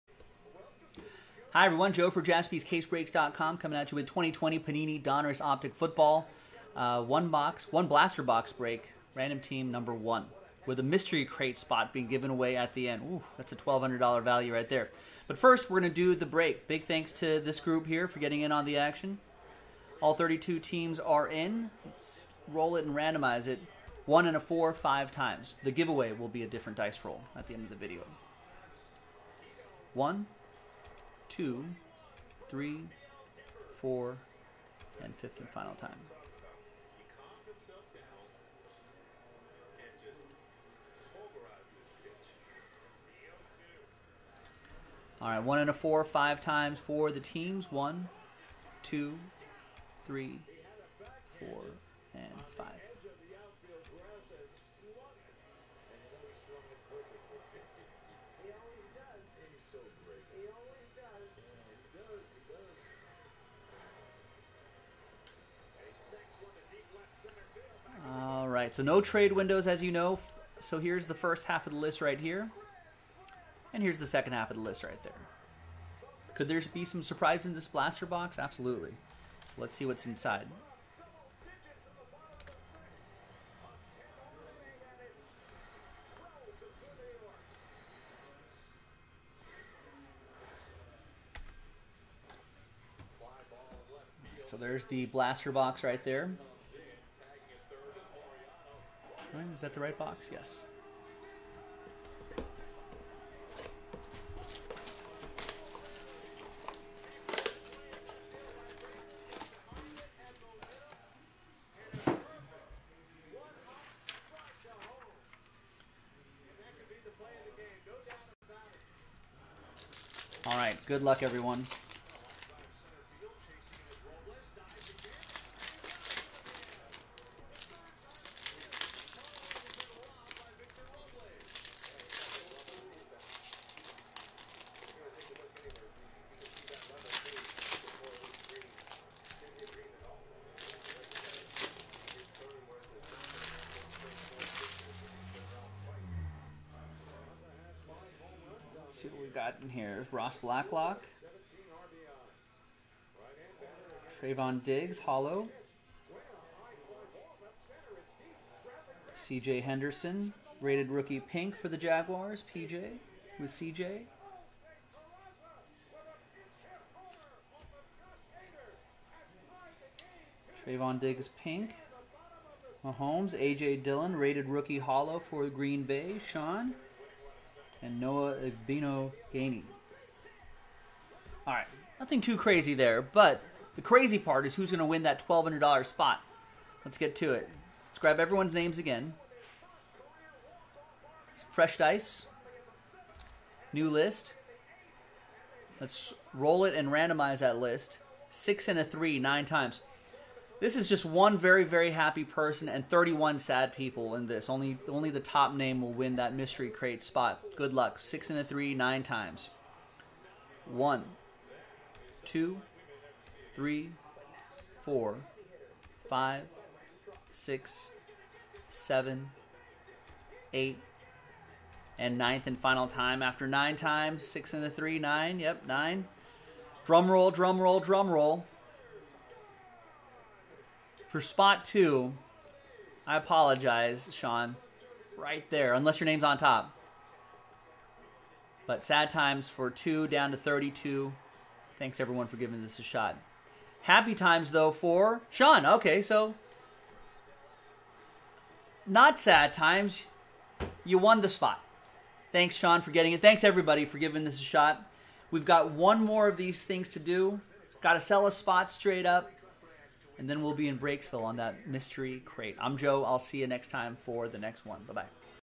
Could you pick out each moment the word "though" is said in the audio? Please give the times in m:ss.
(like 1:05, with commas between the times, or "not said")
4:04.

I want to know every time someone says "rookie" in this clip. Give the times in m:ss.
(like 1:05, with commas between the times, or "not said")
2:40, 2:54.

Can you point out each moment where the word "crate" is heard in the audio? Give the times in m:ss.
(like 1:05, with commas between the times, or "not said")
0:11, 3:26, 4:22.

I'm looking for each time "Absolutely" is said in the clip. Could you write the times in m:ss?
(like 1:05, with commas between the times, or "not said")
1:18.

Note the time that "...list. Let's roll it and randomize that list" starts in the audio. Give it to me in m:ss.
3:13.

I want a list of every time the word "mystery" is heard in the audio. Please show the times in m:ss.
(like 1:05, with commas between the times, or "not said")
0:10, 3:26, 4:21.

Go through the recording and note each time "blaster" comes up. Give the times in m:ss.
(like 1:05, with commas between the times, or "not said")
0:07, 1:17, 1:35.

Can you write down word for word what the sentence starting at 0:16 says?
Big thanks to this group here for getting in on the action.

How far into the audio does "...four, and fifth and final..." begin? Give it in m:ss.
0:33.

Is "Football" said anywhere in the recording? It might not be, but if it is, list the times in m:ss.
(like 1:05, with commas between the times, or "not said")
0:05.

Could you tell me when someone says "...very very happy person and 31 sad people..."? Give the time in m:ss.
3:21.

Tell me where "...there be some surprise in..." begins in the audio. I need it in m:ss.
1:16.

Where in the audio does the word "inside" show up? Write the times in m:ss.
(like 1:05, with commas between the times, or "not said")
1:20.